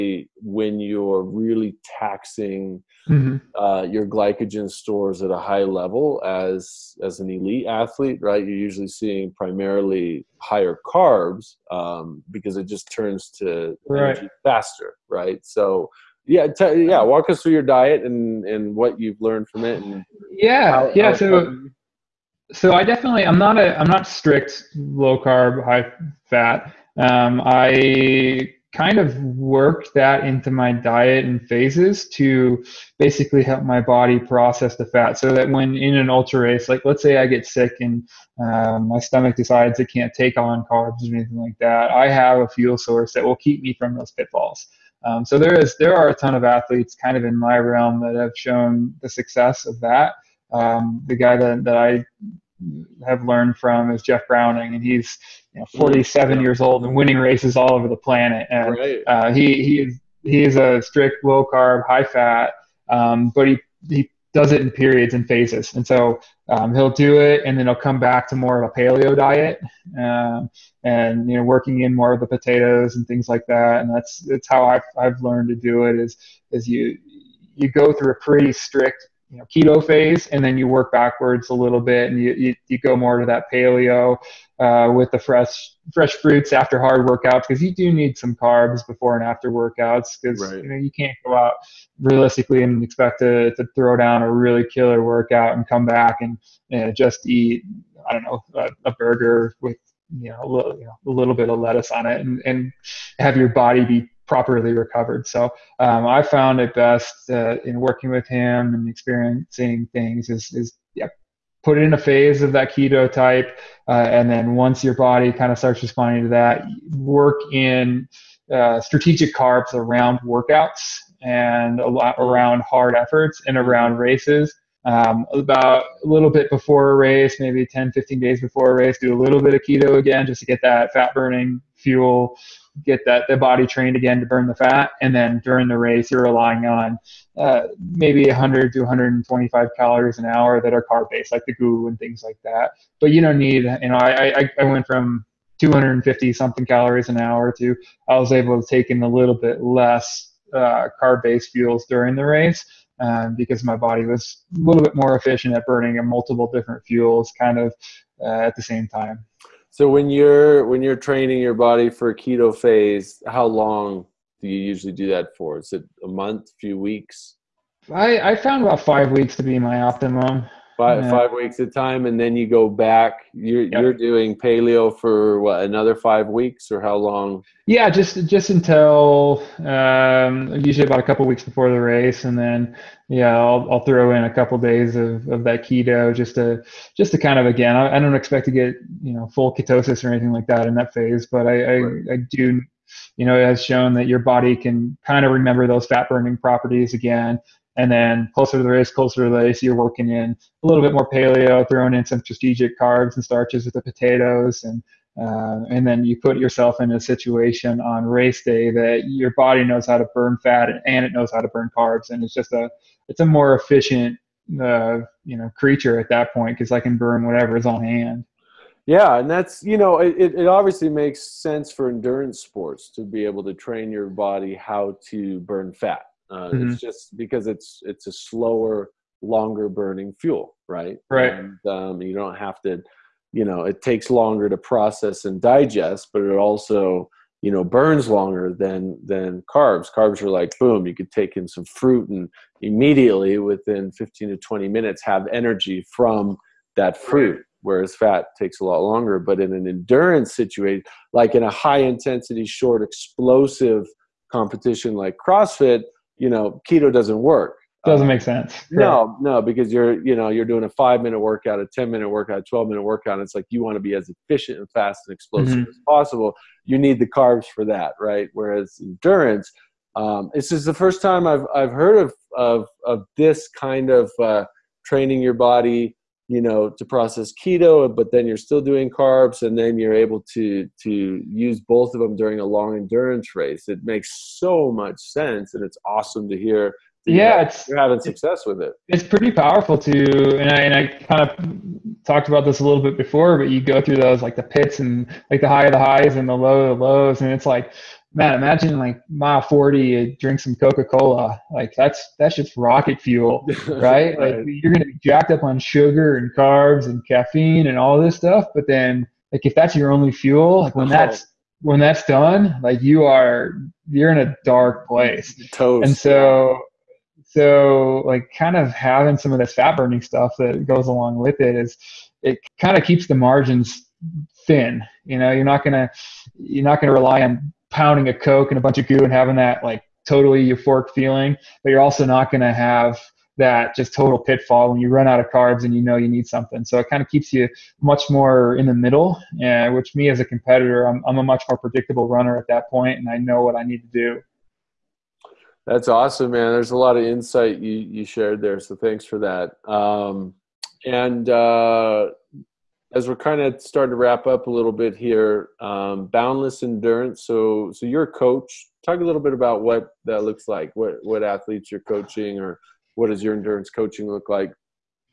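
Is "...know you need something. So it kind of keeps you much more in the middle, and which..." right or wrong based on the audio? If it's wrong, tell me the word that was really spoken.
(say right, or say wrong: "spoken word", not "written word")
right.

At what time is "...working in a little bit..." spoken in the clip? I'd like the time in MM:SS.
03:19.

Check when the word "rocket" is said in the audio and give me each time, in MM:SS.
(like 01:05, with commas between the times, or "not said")
05:02.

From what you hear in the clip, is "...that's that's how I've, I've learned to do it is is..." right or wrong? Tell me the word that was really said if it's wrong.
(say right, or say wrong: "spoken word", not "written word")
right.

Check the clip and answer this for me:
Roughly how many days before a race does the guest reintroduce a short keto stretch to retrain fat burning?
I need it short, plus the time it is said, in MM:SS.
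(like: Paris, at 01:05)
10 to 15 days, at 02:07.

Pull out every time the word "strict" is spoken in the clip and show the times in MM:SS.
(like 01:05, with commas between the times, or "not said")
00:24, 01:00, 01:18.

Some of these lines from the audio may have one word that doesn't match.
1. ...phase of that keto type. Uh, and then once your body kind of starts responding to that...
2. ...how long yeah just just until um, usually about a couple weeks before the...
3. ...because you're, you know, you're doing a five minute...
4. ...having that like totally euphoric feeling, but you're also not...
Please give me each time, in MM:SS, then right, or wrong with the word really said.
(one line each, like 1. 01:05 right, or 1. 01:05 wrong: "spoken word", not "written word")
1. 01:51 right
2. 02:56 right
3. 04:19 right
4. 05:29 right.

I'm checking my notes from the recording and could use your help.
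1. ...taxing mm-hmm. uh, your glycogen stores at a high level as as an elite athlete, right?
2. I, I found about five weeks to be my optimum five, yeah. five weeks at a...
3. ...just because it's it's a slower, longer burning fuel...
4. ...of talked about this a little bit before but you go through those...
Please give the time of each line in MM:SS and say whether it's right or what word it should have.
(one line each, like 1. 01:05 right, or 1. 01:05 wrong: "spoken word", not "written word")
1. 00:01 right
2. 02:47 right
3. 03:46 right
4. 04:51 right.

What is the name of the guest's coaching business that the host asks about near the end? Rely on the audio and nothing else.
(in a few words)
Boundless Endurance.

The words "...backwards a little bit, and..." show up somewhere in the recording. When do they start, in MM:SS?
01:20.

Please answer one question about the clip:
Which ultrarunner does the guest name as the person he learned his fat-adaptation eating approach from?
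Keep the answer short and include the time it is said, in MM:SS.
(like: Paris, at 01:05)
Jeff Browning, at 00:54.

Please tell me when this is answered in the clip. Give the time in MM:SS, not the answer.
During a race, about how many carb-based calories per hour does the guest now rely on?
02:18.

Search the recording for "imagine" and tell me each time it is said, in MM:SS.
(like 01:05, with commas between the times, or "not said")
04:58.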